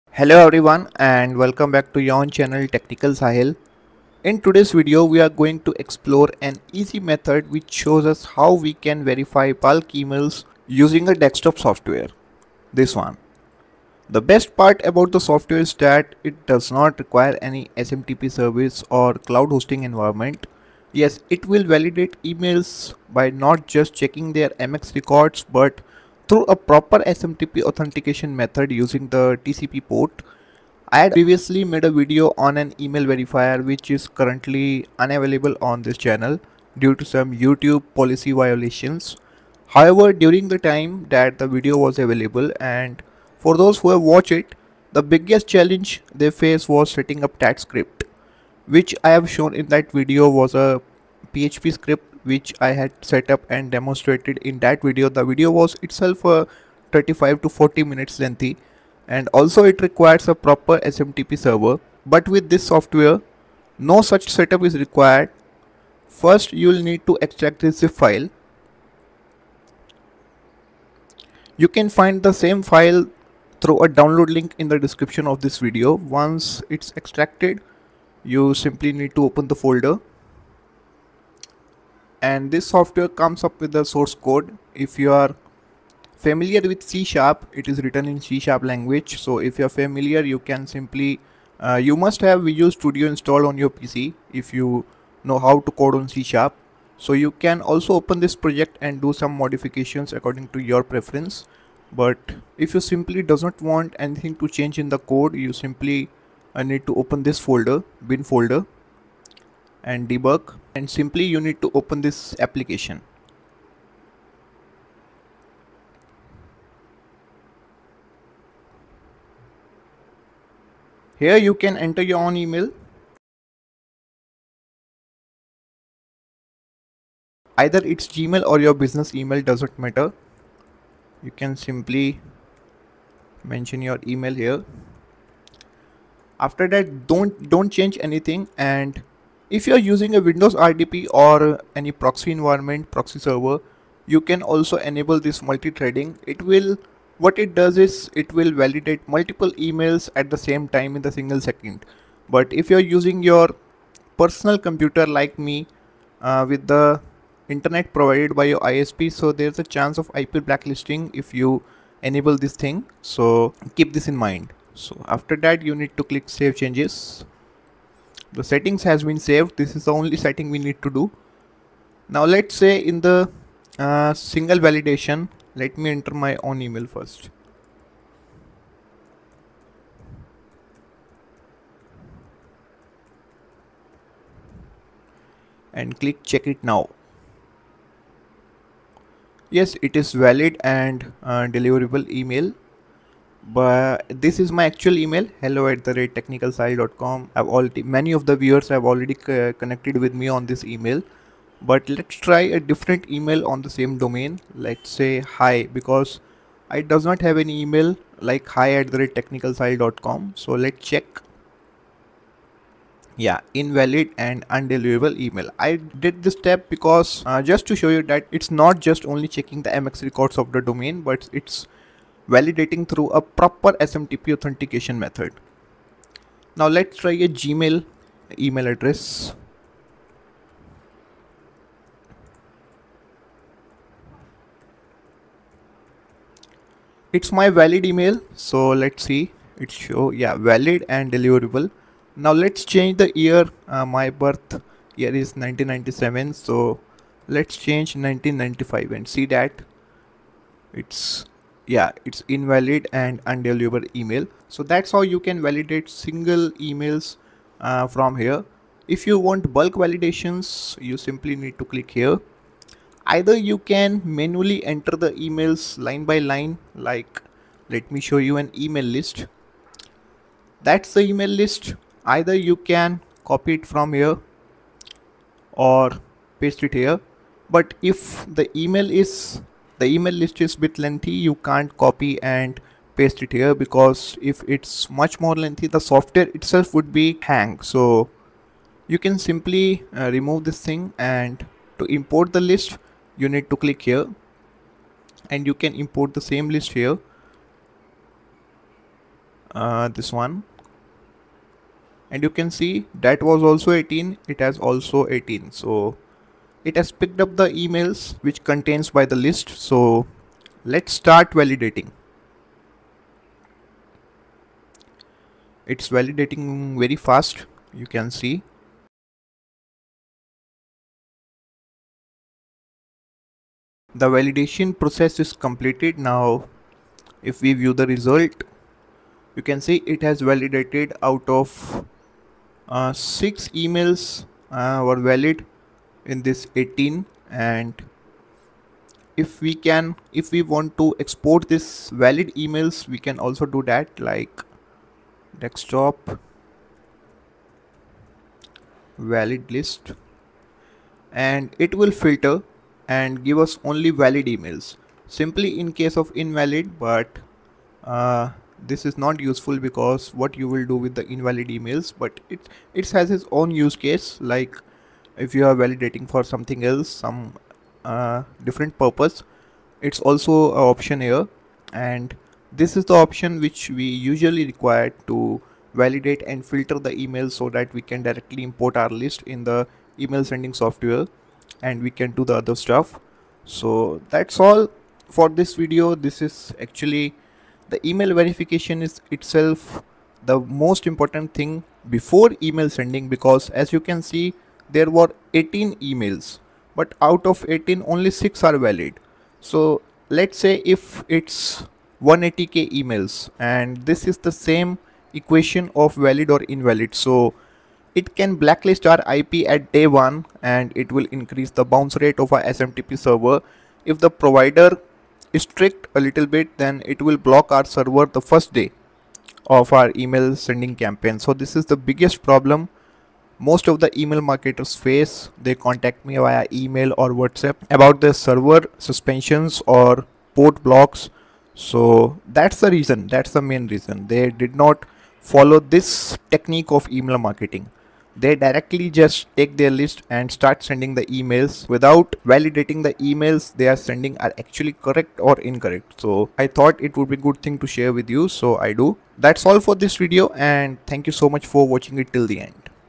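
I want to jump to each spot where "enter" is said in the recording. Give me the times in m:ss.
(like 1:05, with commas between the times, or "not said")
2:01, 2:55, 4:24.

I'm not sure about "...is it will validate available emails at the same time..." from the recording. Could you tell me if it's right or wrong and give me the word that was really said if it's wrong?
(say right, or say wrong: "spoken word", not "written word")
wrong: "multiple", not "available".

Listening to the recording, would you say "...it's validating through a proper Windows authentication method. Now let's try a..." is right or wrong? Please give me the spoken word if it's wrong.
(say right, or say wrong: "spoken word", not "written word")
wrong: "SMTP", not "Windows".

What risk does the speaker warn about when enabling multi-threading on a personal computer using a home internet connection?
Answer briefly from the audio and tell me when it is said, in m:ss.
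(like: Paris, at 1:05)
IP blacklisting, at 2:40.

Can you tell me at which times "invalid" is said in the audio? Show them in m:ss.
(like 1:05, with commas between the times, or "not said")
3:33, 4:12, 5:56, 6:01, 6:46.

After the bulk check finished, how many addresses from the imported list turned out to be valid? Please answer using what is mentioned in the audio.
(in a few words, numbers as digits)
6.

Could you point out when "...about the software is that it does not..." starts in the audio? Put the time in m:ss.
0:14.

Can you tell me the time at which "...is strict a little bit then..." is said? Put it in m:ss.
6:55.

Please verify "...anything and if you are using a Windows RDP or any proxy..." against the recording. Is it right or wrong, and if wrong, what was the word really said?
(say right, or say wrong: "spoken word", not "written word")
right.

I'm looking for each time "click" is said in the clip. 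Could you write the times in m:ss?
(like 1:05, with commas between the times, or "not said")
2:46, 3:05, 4:21, 4:53.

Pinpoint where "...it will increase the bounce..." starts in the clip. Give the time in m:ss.
6:50.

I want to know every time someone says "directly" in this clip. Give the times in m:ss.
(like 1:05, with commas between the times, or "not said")
6:18, 7:18.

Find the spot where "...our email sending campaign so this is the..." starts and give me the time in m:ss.
6:59.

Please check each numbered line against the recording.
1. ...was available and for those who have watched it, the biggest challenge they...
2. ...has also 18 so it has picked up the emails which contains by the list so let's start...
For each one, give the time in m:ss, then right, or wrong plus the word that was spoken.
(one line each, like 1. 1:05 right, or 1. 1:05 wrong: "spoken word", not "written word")
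1. 0:41 right
2. 5:04 right.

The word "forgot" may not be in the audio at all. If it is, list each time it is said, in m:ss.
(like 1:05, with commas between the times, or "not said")
not said.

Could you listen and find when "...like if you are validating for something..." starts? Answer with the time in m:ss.
6:04.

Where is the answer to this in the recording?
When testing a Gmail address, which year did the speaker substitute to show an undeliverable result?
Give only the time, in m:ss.
4:07.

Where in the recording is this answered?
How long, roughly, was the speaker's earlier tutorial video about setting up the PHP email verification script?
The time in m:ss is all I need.
0:56.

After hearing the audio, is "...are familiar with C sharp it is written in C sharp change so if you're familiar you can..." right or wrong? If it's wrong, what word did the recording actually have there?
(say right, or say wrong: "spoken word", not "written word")
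wrong: "language", not "change".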